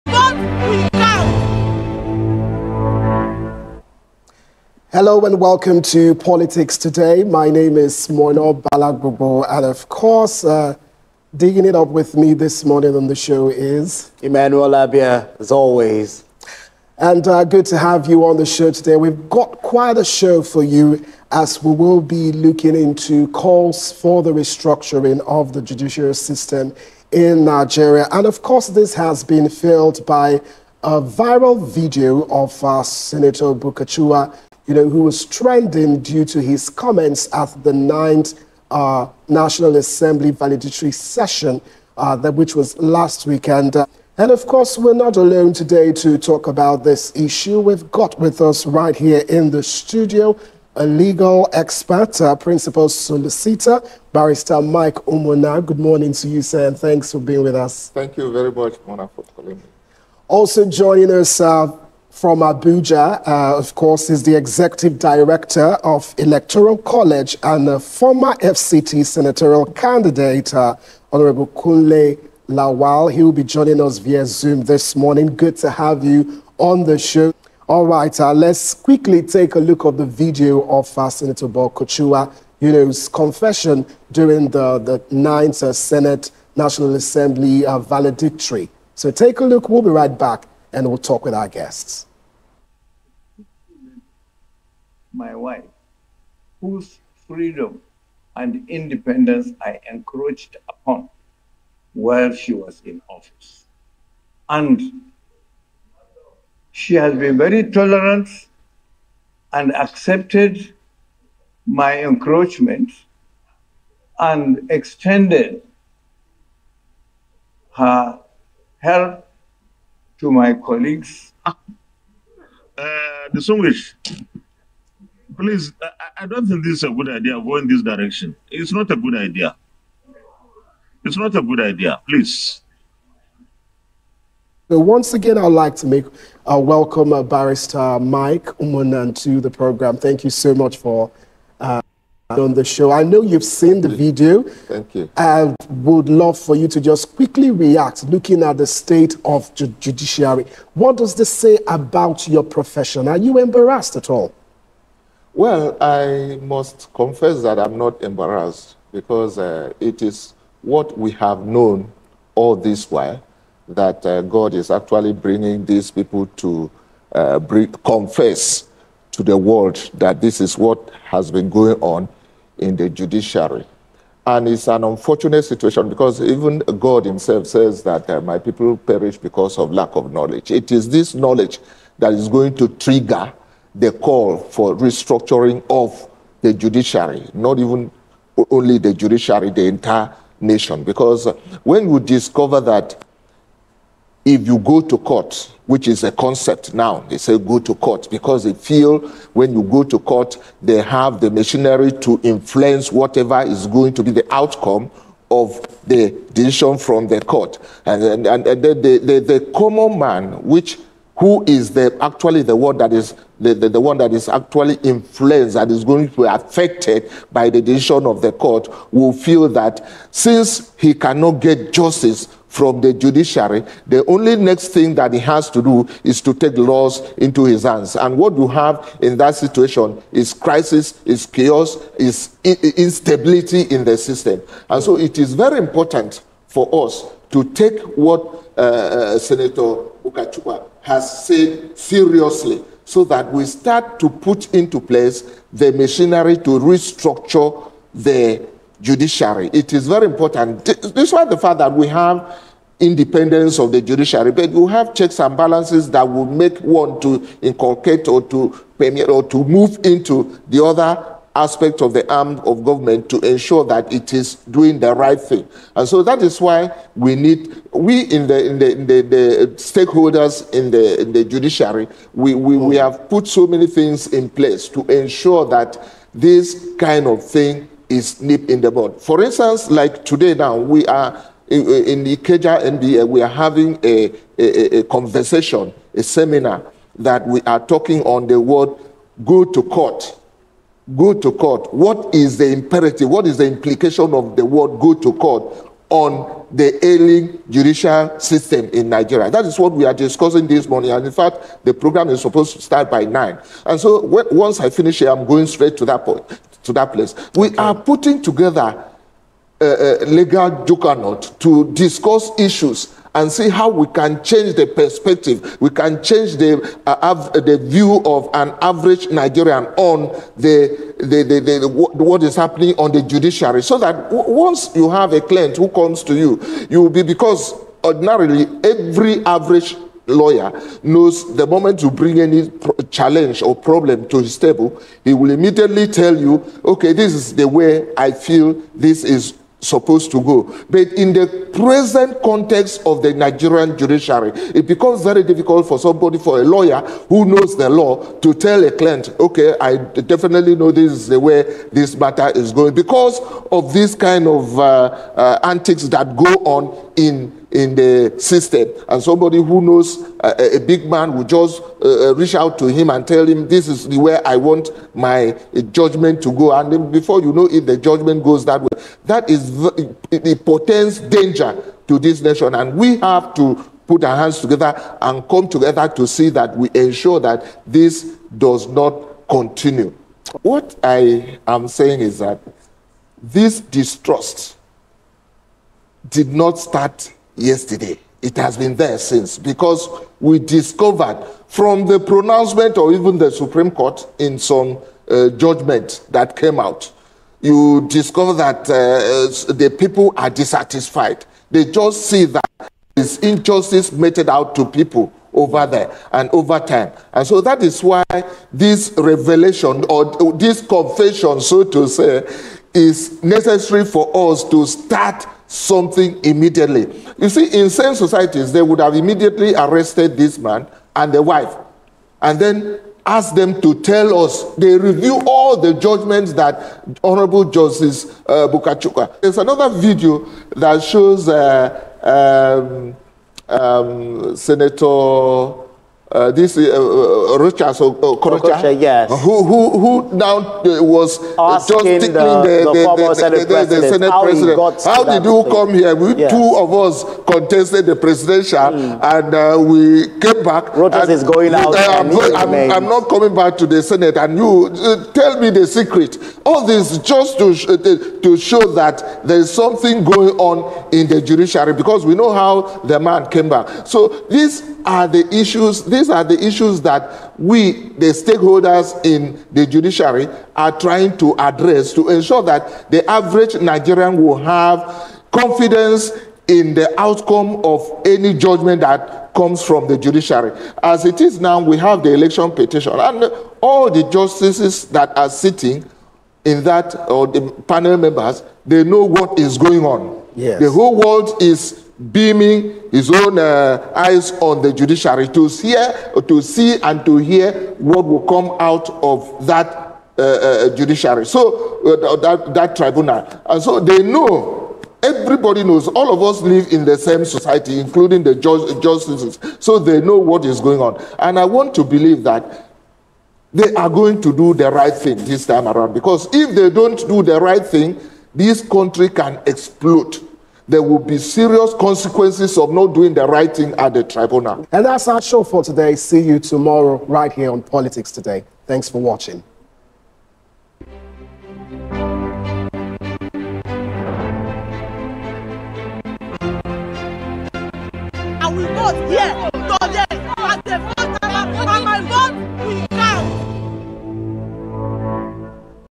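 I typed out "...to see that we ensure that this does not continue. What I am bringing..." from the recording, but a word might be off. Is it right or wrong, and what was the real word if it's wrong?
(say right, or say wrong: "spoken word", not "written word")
wrong: "saying", not "bringing".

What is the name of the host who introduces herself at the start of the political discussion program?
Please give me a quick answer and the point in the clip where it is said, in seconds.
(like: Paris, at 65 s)
Moino Balagbobo, at 8 s.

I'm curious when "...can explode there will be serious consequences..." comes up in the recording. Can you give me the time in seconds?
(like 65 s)
519 s.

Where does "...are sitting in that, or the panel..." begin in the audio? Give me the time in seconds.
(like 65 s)
485 s.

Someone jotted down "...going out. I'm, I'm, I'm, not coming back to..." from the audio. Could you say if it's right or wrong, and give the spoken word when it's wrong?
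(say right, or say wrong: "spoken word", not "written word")
right.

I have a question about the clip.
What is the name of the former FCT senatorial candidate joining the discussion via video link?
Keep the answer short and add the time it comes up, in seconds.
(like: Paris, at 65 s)
Kunle Lawal, at 71 s.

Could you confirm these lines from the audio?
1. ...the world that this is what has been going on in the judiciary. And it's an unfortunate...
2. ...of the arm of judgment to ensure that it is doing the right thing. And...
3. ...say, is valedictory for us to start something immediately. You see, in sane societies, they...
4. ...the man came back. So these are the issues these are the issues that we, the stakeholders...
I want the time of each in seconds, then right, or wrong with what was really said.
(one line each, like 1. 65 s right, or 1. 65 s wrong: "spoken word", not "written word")
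1. 169 s right
2. 261 s wrong: "government", not "judgment"
3. 411 s wrong: "necessary", not "valedictory"
4. 462 s right.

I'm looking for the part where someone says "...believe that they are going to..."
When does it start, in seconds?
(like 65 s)
511 s.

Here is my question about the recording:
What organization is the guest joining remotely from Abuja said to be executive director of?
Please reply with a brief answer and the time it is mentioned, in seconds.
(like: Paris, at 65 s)
Electoral College, at 66 s.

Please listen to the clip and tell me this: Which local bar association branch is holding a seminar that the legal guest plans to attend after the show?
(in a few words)
Ikeja NBA.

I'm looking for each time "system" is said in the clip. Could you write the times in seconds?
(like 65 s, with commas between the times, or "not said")
26 s, 233 s, 298 s, 358 s.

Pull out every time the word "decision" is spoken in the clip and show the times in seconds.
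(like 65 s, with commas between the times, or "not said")
206 s, 217 s.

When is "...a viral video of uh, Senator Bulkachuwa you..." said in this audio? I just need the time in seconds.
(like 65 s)
30 s.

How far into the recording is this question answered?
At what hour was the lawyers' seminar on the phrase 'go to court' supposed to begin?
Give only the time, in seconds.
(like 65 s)
303 s.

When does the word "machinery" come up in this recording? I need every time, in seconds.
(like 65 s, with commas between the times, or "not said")
201 s, 245 s.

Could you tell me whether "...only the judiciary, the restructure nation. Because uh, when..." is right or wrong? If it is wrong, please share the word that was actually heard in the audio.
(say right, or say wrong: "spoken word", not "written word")
wrong: "entire", not "restructure".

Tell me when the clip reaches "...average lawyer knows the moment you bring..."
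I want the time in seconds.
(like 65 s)
329 s.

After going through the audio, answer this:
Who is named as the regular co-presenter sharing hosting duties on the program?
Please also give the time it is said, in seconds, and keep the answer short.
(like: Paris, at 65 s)
Emmanuel Abia, at 14 s.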